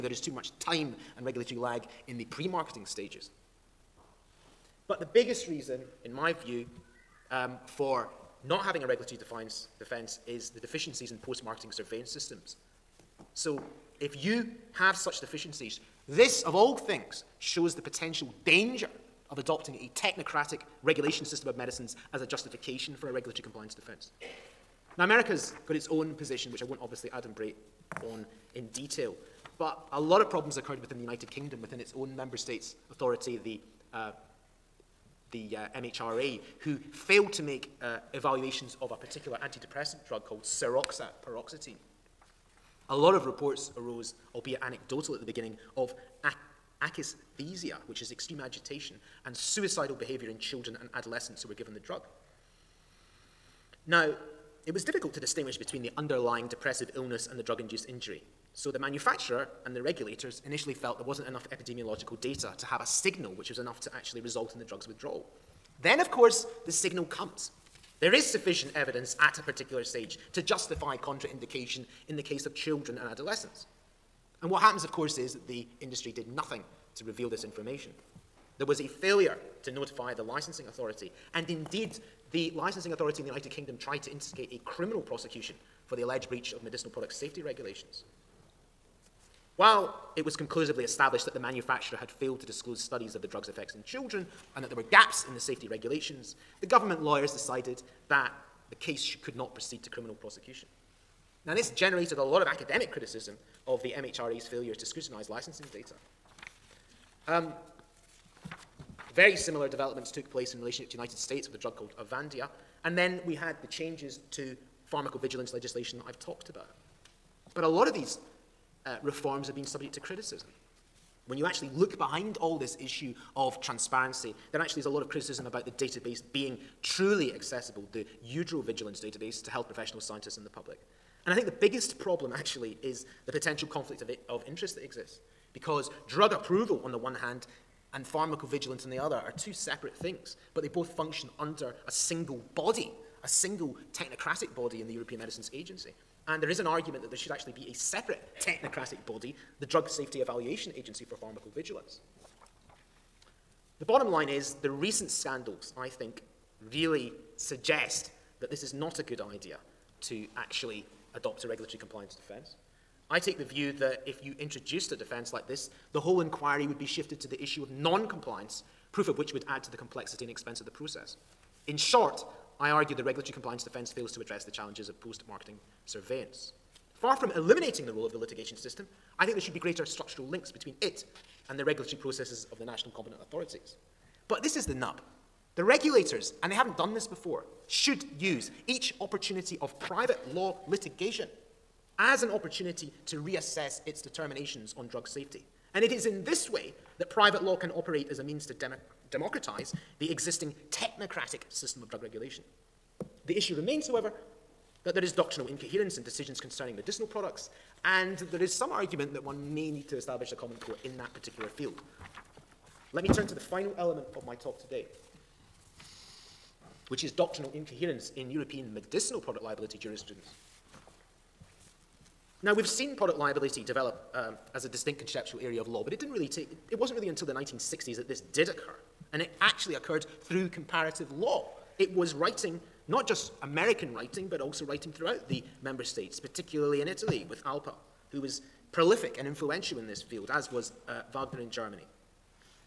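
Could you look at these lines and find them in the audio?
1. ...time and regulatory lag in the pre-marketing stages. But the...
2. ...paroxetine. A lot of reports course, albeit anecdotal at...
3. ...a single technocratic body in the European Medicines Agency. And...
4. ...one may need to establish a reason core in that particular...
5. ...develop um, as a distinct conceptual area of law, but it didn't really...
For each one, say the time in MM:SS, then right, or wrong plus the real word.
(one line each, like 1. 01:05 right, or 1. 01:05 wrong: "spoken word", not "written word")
1. 00:00 right
2. 00:41 wrong: "arose", not "course"
3. 02:23 right
4. 03:29 wrong: "common", not "reason"
5. 03:43 right.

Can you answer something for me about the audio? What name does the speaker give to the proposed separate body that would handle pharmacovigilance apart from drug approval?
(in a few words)
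Drug Safety Evaluation Agency.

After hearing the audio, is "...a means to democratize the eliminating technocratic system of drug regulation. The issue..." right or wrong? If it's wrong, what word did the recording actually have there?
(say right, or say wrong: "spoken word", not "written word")
wrong: "existing", not "eliminating".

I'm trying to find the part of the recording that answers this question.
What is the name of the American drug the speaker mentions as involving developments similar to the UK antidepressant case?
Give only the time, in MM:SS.
01:51.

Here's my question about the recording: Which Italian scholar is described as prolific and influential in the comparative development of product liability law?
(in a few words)
Alpa.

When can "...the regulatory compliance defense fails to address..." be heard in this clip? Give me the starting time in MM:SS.
02:52.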